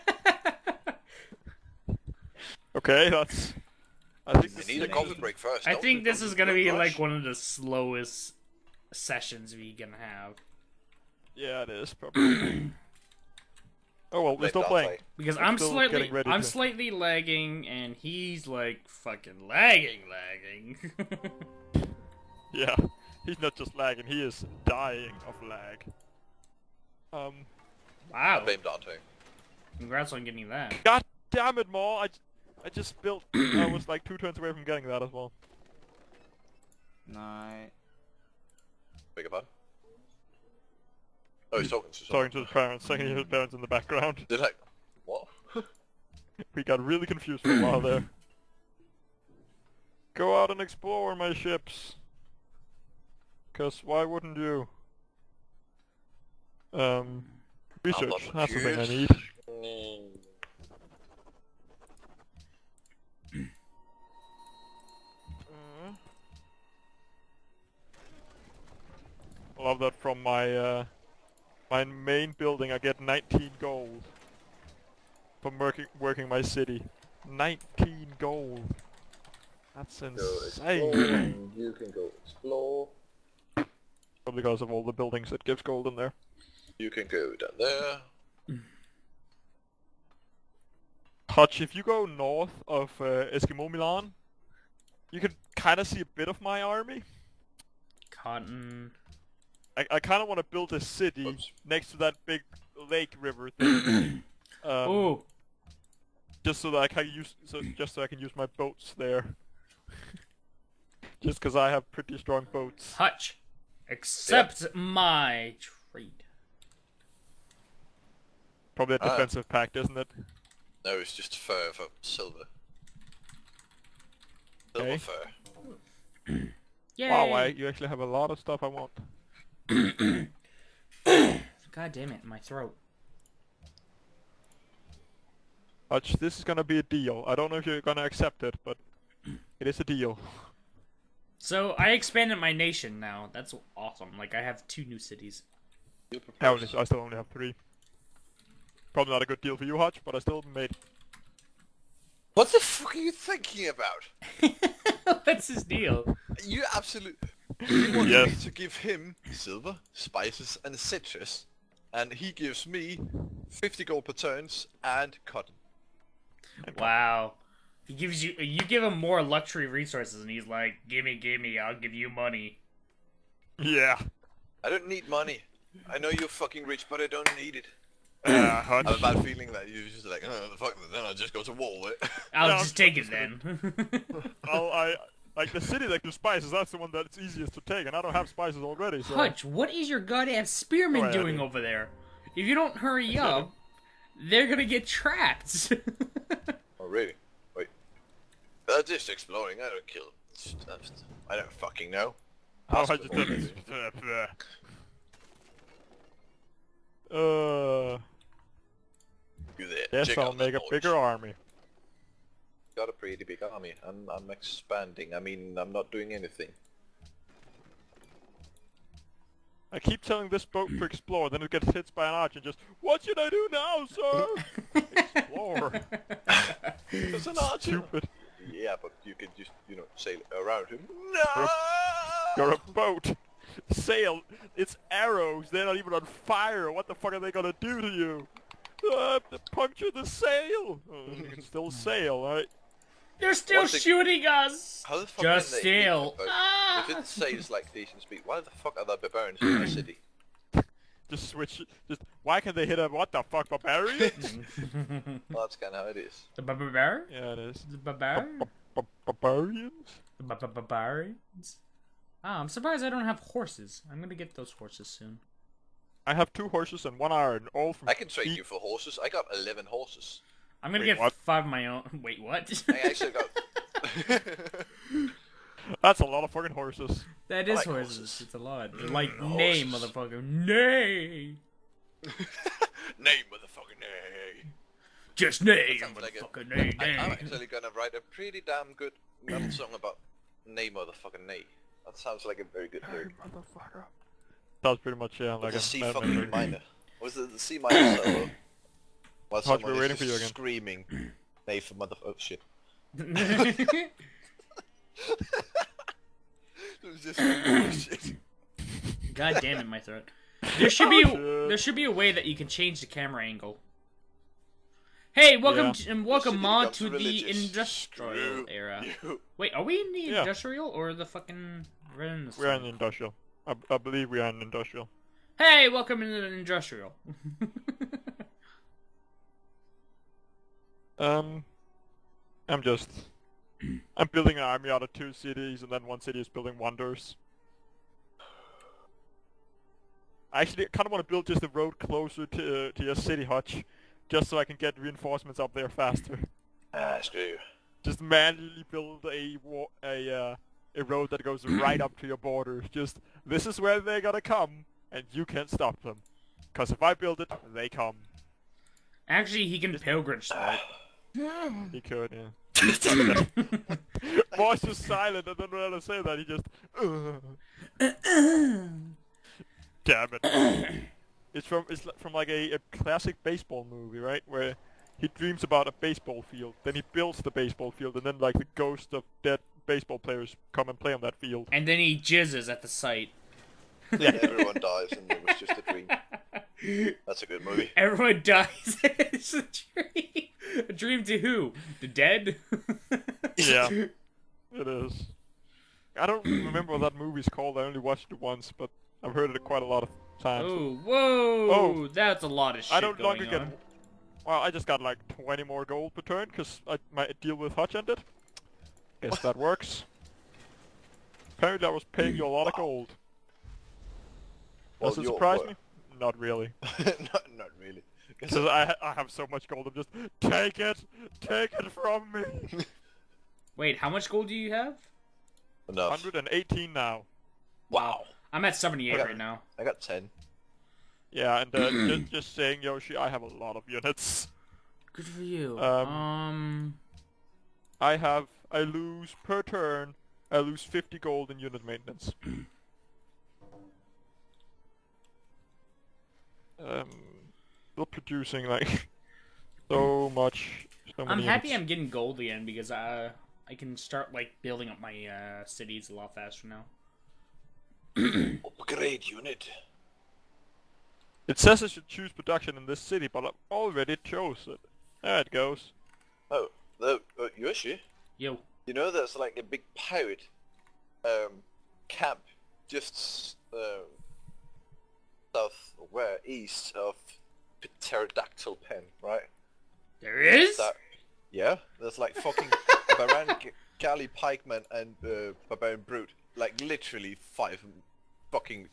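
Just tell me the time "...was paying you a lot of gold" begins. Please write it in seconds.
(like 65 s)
411 s.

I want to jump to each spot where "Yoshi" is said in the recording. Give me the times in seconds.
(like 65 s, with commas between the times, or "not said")
432 s, 467 s.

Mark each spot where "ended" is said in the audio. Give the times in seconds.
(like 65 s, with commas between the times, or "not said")
407 s.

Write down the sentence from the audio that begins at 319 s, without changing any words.
Wait, are we in the yeah.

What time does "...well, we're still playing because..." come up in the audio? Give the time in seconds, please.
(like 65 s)
14 s.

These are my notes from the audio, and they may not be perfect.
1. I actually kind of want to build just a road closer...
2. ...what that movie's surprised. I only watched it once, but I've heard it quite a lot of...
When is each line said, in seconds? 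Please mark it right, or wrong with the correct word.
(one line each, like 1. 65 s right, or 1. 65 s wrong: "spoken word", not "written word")
1. 340 s right
2. 396 s wrong: "called", not "surprised".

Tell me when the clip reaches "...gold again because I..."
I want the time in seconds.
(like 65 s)
451 s.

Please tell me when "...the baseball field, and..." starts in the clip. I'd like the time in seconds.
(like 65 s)
377 s.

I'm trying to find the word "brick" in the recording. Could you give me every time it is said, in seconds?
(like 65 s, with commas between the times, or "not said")
not said.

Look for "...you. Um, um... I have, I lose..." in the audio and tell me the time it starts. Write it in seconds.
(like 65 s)
435 s.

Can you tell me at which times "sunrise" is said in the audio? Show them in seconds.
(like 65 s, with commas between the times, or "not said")
not said.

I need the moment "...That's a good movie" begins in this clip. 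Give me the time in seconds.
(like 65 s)
387 s.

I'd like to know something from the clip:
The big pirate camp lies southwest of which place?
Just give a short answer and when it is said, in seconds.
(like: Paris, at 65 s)
pterodactyl pen, at 477 s.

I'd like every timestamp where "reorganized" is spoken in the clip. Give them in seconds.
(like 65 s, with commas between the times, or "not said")
not said.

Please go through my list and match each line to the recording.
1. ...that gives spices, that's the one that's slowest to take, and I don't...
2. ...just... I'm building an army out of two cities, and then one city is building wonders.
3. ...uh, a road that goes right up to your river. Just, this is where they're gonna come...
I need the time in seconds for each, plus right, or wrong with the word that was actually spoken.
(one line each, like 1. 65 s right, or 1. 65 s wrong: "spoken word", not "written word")
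1. 185 s wrong: "easiest", not "slowest"
2. 332 s right
3. 350 s wrong: "border", not "river".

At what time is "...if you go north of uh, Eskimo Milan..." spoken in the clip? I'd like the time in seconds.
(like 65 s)
91 s.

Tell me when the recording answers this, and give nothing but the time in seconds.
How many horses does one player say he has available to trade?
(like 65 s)
269 s.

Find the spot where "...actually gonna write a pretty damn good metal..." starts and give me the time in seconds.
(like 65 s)
287 s.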